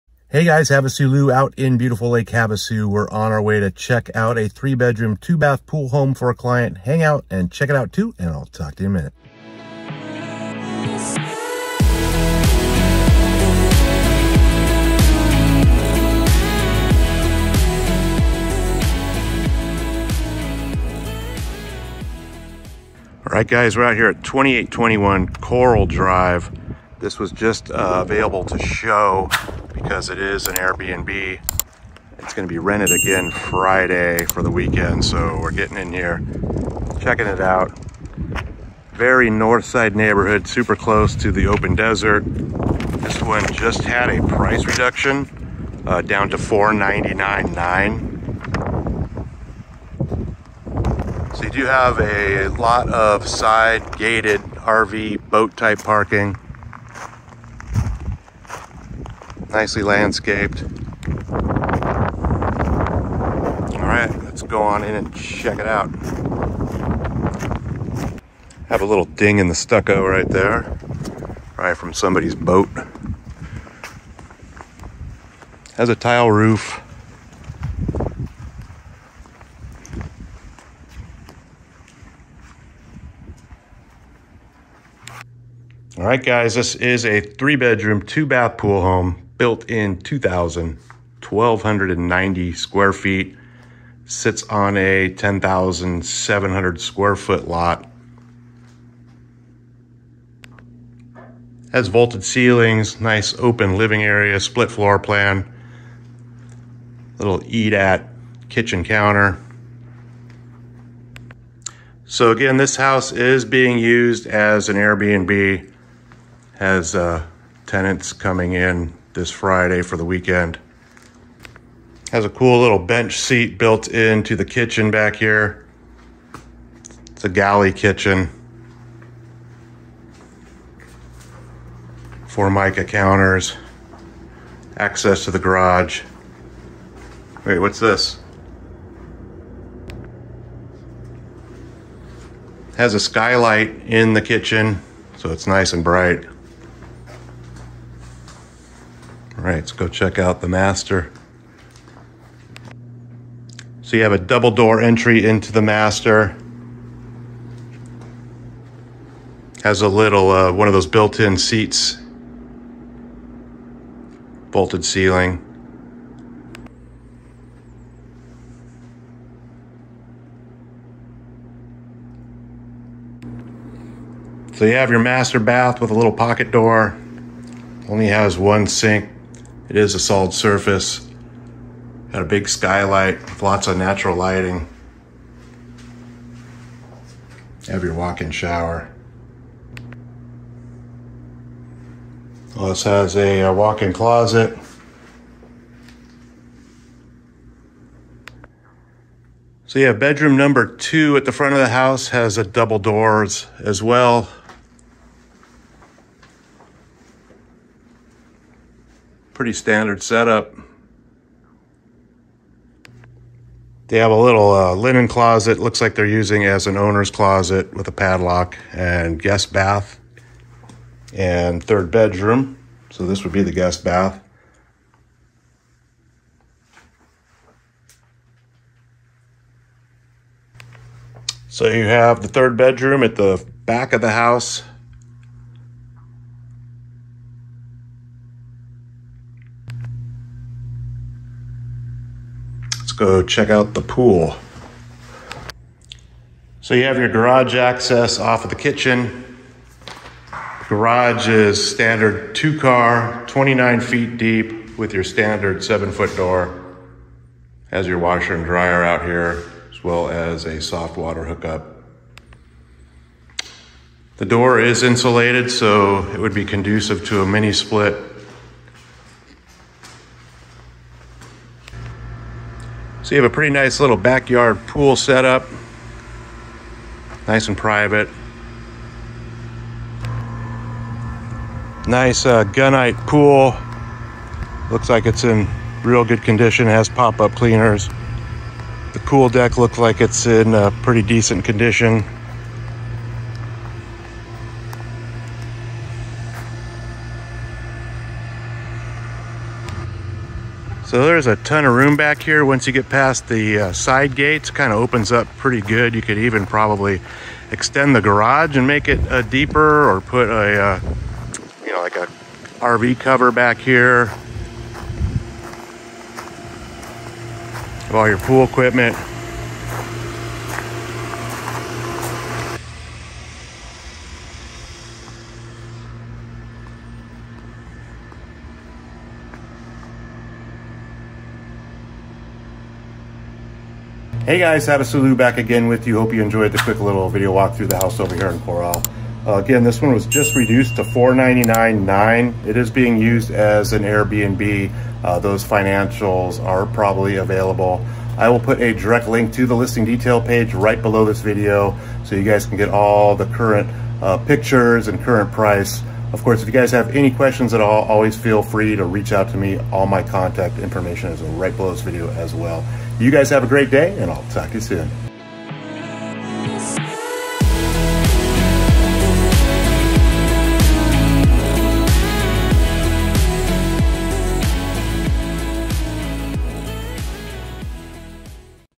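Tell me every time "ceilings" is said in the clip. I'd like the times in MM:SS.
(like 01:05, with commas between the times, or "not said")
01:42, 02:44.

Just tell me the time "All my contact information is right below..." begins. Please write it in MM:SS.
05:59.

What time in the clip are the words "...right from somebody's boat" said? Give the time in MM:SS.
01:11.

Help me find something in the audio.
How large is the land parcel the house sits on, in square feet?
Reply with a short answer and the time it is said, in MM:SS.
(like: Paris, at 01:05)
10,700, at 01:35.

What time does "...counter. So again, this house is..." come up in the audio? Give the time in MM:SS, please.
01:48.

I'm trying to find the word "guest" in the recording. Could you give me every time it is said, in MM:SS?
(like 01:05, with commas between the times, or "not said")
03:39, 03:43.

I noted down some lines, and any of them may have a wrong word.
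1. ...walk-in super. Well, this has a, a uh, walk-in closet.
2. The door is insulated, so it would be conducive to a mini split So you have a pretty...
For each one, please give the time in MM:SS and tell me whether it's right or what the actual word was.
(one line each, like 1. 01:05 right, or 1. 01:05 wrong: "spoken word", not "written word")
1. 03:07 wrong: "shower", not "super"
2. 04:24 right.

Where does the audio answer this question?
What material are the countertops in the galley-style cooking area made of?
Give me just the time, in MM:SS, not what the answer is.
02:12.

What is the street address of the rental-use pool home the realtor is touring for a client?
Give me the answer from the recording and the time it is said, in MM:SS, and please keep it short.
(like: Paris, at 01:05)
2821 Corral Drive, at 00:24.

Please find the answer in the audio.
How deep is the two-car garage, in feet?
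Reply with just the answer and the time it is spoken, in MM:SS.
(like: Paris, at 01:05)
29 feet, at 04:13.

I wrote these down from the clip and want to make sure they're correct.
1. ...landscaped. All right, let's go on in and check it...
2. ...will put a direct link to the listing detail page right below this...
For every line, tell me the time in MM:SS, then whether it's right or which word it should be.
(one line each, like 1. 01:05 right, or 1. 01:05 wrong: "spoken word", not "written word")
1. 00:59 right
2. 05:48 right.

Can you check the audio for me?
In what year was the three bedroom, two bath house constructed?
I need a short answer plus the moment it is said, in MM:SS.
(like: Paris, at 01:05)
2000, at 01:29.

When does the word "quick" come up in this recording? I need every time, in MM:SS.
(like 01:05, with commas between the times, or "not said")
05:36.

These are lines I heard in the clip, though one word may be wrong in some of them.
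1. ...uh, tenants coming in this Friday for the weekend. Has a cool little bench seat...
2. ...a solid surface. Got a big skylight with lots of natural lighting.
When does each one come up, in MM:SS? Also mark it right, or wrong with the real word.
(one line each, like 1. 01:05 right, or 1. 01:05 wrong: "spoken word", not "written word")
1. 01:56 right
2. 02:59 right.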